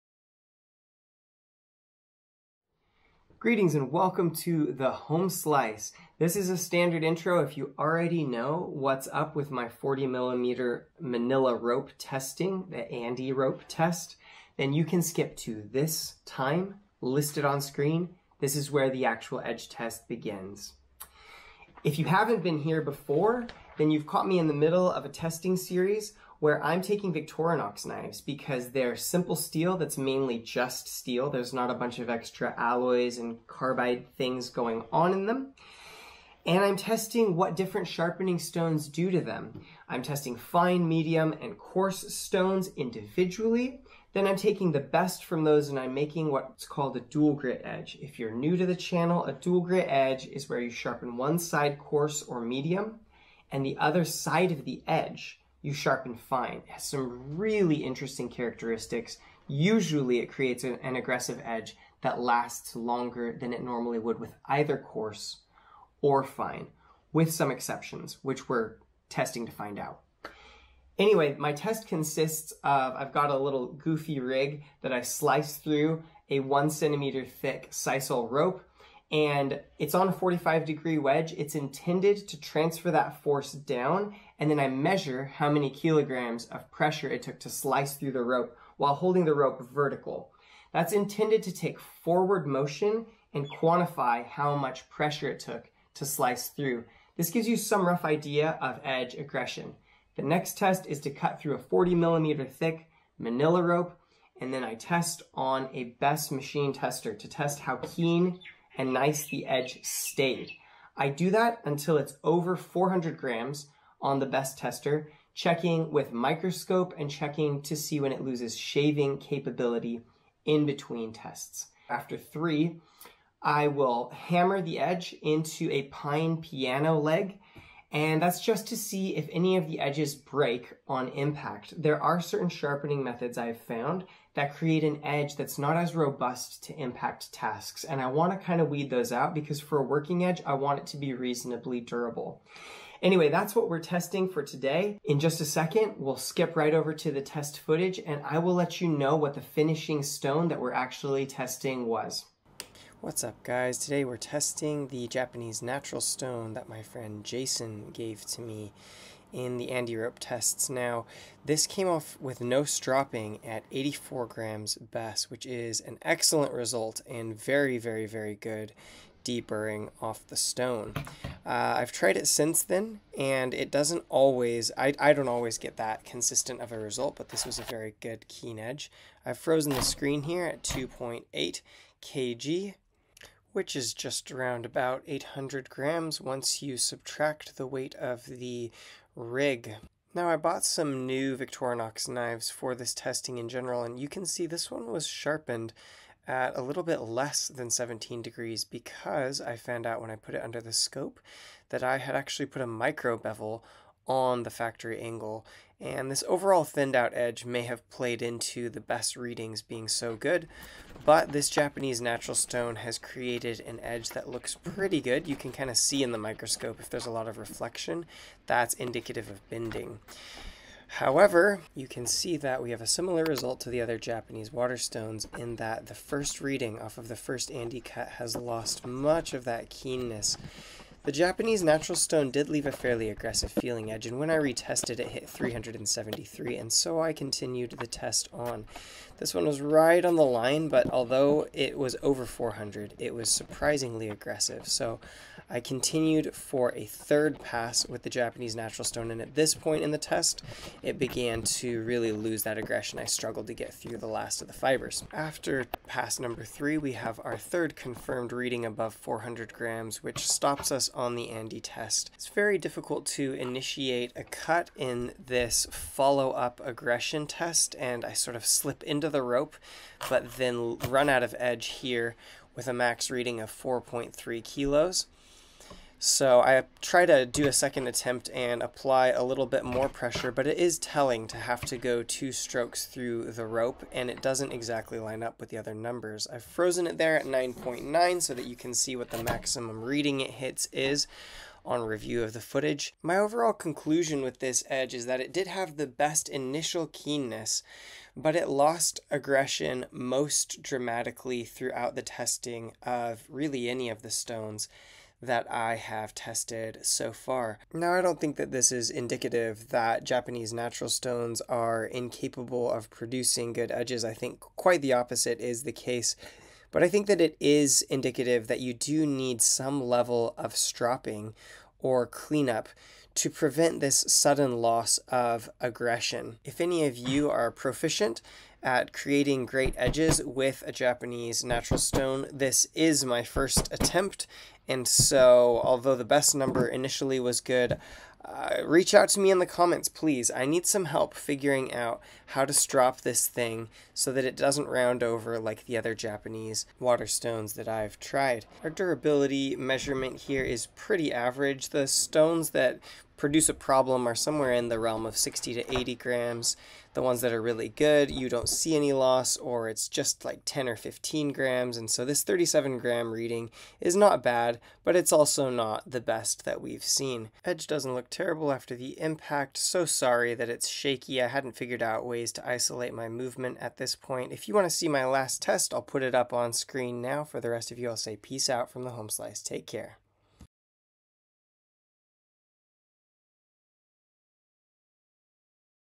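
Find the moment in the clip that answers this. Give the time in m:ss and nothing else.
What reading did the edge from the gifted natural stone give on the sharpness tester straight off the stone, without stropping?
2:43.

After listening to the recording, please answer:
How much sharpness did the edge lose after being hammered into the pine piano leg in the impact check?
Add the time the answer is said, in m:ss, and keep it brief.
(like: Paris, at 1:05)
37 grams, at 6:02.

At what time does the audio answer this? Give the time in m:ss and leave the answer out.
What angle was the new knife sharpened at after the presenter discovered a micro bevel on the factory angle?
3:17.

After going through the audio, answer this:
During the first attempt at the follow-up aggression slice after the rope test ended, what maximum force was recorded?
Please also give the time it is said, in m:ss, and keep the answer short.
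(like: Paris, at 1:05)
4.3 kilos, at 4:33.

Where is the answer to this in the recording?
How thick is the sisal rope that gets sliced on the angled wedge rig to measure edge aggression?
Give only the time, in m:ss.
1:16.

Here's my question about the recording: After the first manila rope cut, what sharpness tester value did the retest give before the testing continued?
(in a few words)
373.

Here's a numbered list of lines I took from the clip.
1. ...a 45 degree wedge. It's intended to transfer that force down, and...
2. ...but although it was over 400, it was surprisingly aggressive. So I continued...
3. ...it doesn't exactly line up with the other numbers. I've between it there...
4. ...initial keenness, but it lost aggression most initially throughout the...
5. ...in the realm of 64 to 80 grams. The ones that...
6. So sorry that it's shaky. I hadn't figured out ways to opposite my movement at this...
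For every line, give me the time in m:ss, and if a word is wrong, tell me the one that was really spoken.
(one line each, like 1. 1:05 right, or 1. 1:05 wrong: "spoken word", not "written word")
1. 1:20 right
2. 4:00 right
3. 4:44 wrong: "frozen", not "between"
4. 4:56 wrong: "dramatically", not "initially"
5. 5:54 wrong: "60", not "64"
6. 6:09 wrong: "isolate", not "opposite".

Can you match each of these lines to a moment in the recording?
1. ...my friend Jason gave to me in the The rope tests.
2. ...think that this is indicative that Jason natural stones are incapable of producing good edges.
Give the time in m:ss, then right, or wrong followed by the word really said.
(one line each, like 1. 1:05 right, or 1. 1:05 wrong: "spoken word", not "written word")
1. 2:36 wrong: "ANDE", not "The"
2. 5:08 wrong: "Japanese", not "Jason".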